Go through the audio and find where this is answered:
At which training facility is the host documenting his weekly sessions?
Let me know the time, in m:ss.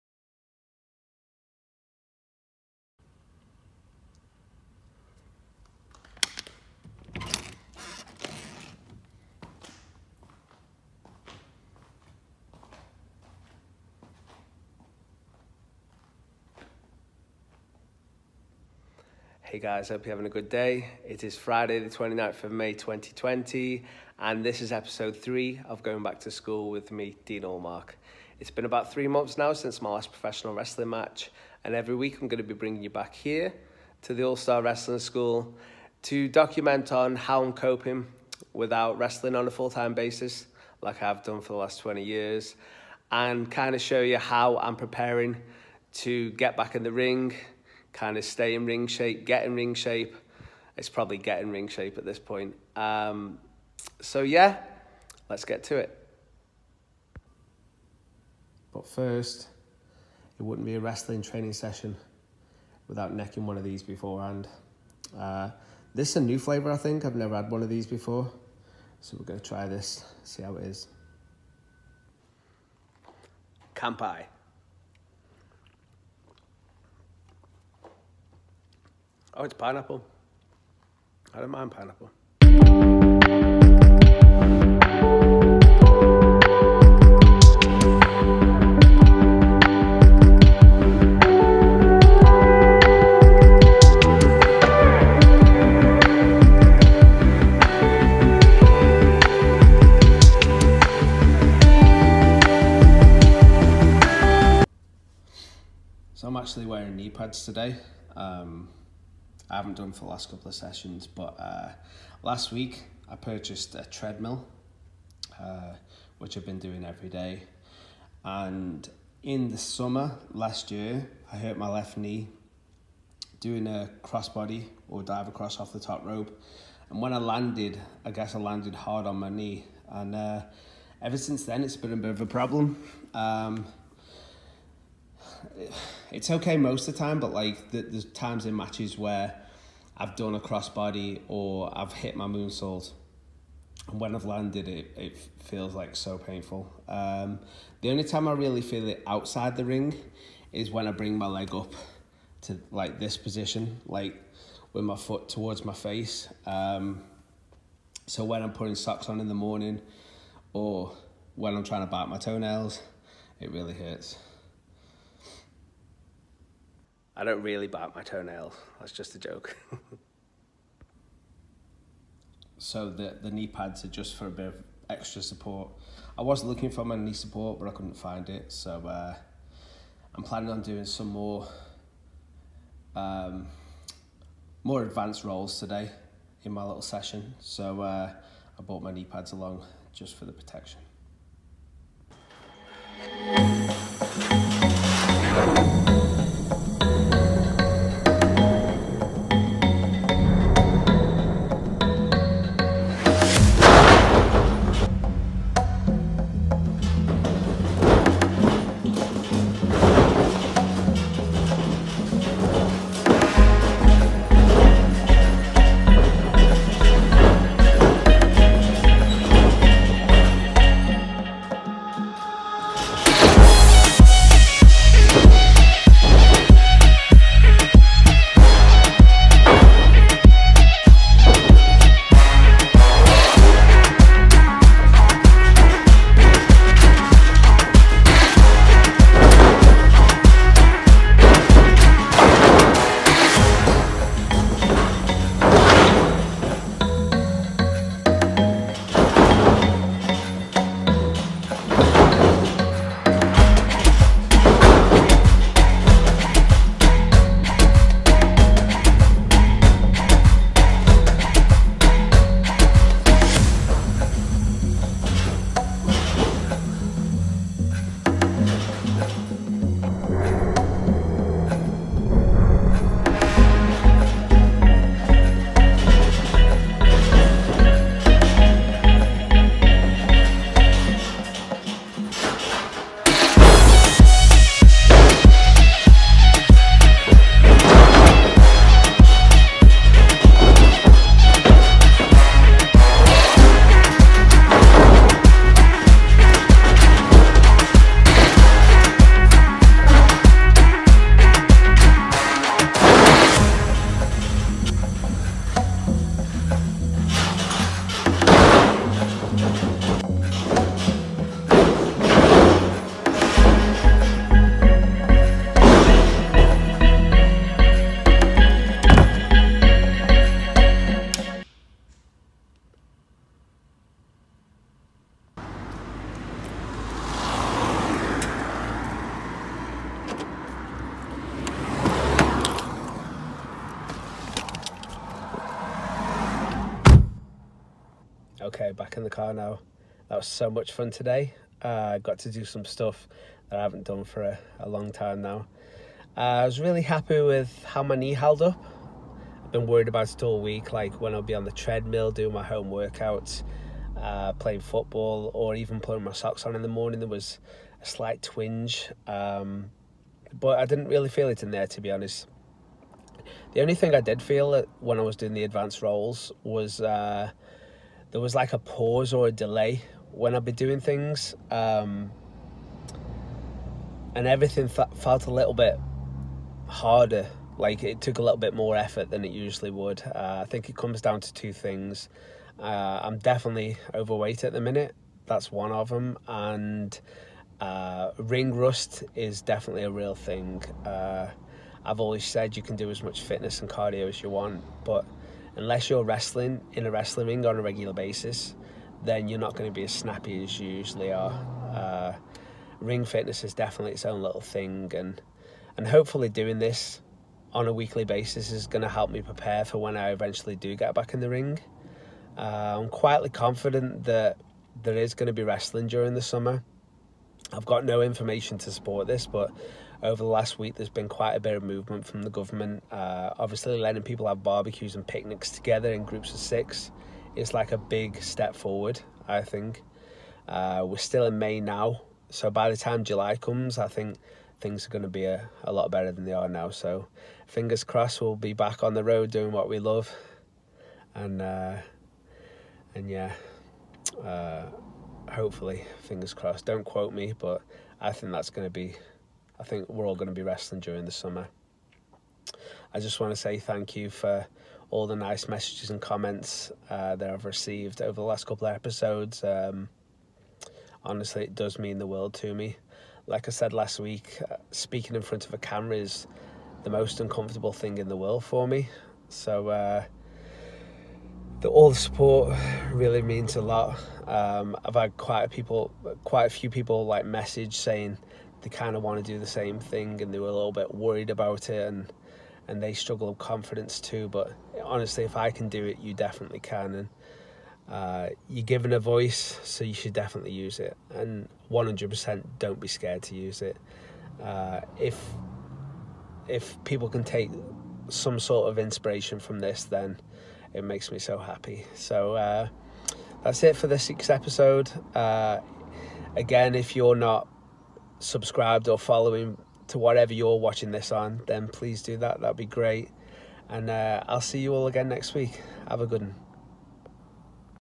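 0:34.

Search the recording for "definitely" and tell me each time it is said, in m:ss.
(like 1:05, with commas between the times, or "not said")
6:23, 6:29, 6:43, 8:06, 8:10.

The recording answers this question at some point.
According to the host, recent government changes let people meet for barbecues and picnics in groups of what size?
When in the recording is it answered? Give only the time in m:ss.
7:06.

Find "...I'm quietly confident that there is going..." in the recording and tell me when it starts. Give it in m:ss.
6:52.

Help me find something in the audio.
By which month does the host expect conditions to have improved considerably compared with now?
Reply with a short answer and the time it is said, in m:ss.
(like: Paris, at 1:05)
July, at 7:13.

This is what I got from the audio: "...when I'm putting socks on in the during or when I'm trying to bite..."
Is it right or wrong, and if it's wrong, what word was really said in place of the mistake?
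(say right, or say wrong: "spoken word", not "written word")
wrong: "morning", not "during".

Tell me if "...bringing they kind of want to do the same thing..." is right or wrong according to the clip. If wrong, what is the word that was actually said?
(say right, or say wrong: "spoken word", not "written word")
wrong: "saying", not "bringing".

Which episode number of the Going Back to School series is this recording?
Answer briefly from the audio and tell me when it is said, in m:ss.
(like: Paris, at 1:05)
3, at 0:24.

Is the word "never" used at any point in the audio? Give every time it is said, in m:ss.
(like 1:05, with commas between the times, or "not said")
1:07.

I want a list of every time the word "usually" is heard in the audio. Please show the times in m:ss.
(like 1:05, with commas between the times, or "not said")
6:19, 6:40.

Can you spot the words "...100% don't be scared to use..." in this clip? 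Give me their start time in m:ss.
8:11.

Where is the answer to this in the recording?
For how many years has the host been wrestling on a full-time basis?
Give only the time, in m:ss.
0:41.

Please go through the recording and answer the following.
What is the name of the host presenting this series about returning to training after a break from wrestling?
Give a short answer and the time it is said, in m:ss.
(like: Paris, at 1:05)
Dean Allmark, at 0:27.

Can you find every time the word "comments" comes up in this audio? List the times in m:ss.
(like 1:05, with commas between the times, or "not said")
7:36.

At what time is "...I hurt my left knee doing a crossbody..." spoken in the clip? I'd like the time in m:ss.
2:01.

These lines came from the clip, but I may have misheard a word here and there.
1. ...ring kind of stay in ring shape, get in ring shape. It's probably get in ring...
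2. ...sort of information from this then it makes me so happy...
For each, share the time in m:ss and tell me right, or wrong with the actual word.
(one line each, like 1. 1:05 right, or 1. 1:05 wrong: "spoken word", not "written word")
1. 0:46 right
2. 8:18 wrong: "inspiration", not "information".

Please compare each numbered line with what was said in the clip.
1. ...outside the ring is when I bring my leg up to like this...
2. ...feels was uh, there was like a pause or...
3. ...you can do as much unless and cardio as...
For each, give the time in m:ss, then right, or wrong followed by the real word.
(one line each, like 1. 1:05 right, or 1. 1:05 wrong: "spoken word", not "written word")
1. 2:29 right
2. 6:05 wrong: "rolls", not "feels"
3. 6:32 wrong: "fitness", not "unless".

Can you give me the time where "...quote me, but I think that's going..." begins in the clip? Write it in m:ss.
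7:26.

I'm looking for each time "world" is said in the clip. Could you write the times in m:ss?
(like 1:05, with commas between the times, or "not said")
7:42, 7:48.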